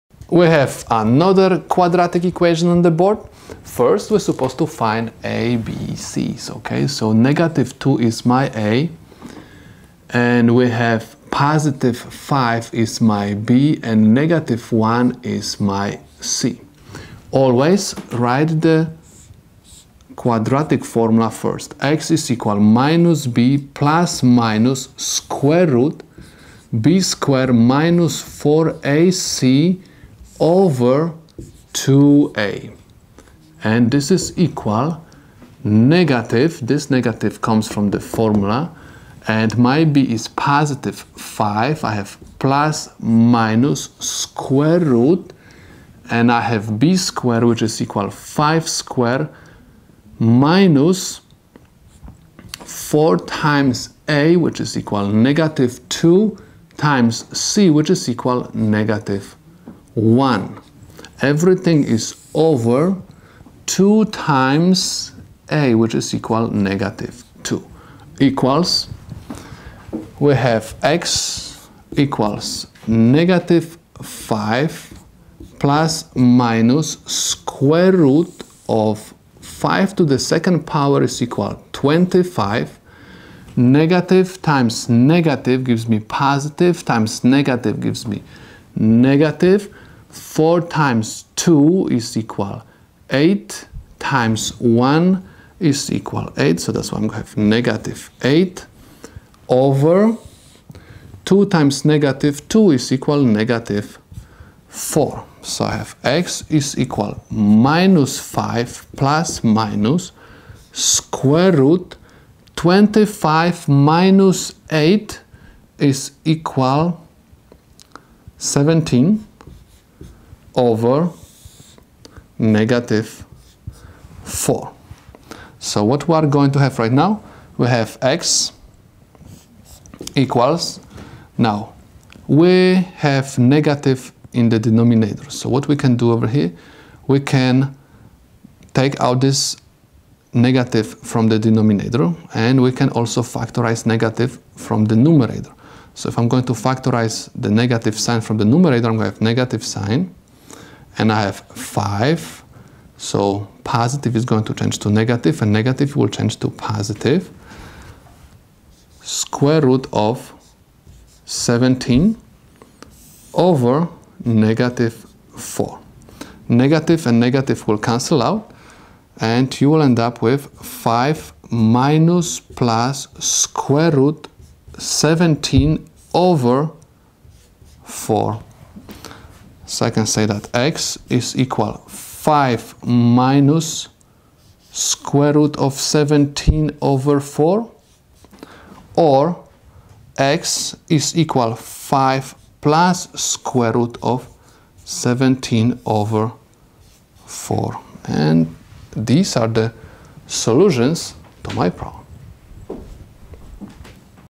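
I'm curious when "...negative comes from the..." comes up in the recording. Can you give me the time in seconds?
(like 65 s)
36 s.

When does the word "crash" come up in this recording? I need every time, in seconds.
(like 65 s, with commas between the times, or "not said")
not said.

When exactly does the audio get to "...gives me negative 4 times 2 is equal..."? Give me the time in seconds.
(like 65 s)
87 s.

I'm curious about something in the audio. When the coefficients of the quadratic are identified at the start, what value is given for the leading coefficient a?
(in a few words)
-2.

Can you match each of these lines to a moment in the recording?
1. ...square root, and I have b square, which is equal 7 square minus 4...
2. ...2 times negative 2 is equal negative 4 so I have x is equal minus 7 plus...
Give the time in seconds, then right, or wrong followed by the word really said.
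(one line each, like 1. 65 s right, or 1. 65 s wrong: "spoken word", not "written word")
1. 43 s wrong: "5", not "7"
2. 101 s wrong: "5", not "7".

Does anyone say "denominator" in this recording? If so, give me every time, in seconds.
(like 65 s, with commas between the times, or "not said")
134 s, 141 s.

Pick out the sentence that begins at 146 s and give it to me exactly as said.
So if I'm going to factorize the negative sign from the numerator, I'm going to have negative sign.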